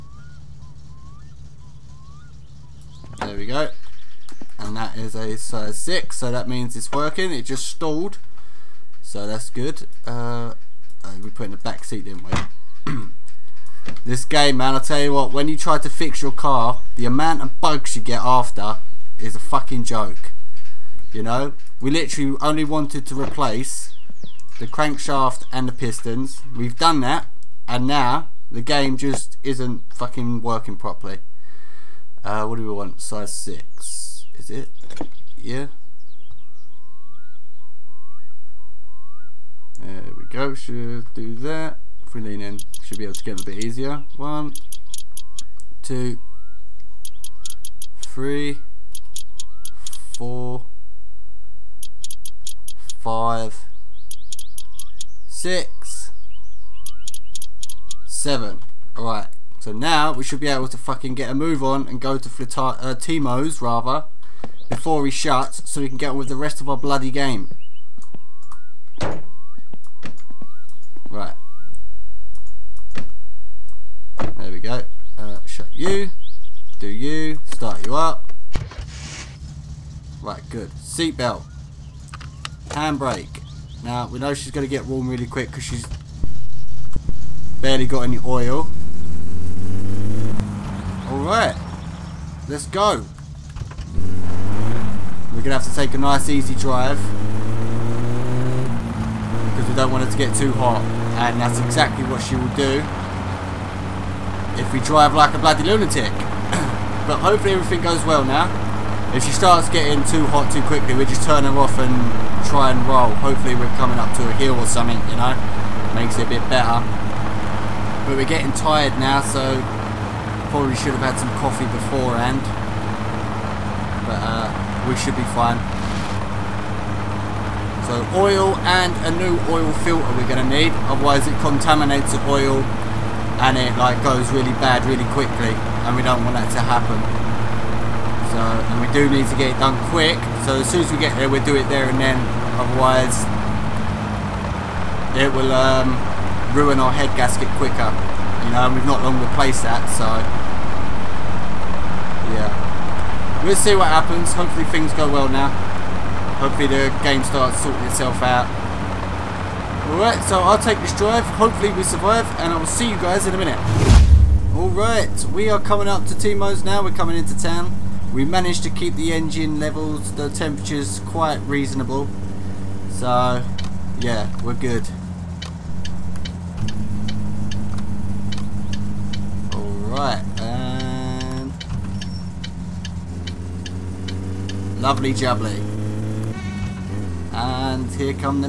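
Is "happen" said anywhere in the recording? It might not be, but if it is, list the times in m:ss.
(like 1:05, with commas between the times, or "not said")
2:16, 2:33.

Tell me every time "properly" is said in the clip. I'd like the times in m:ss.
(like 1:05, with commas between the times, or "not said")
0:30.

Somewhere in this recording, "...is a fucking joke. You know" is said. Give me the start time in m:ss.
0:19.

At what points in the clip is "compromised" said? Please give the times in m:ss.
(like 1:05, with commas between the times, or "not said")
not said.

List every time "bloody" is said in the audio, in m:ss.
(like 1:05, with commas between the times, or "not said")
1:06, 1:45.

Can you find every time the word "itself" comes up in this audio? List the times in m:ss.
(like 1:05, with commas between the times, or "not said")
2:37.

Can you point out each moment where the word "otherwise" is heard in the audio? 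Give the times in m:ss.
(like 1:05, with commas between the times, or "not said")
2:10, 2:22.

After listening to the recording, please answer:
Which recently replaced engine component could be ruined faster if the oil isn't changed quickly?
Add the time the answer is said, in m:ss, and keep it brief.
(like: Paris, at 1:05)
head gasket, at 2:26.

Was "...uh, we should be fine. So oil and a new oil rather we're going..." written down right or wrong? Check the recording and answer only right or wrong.
wrong.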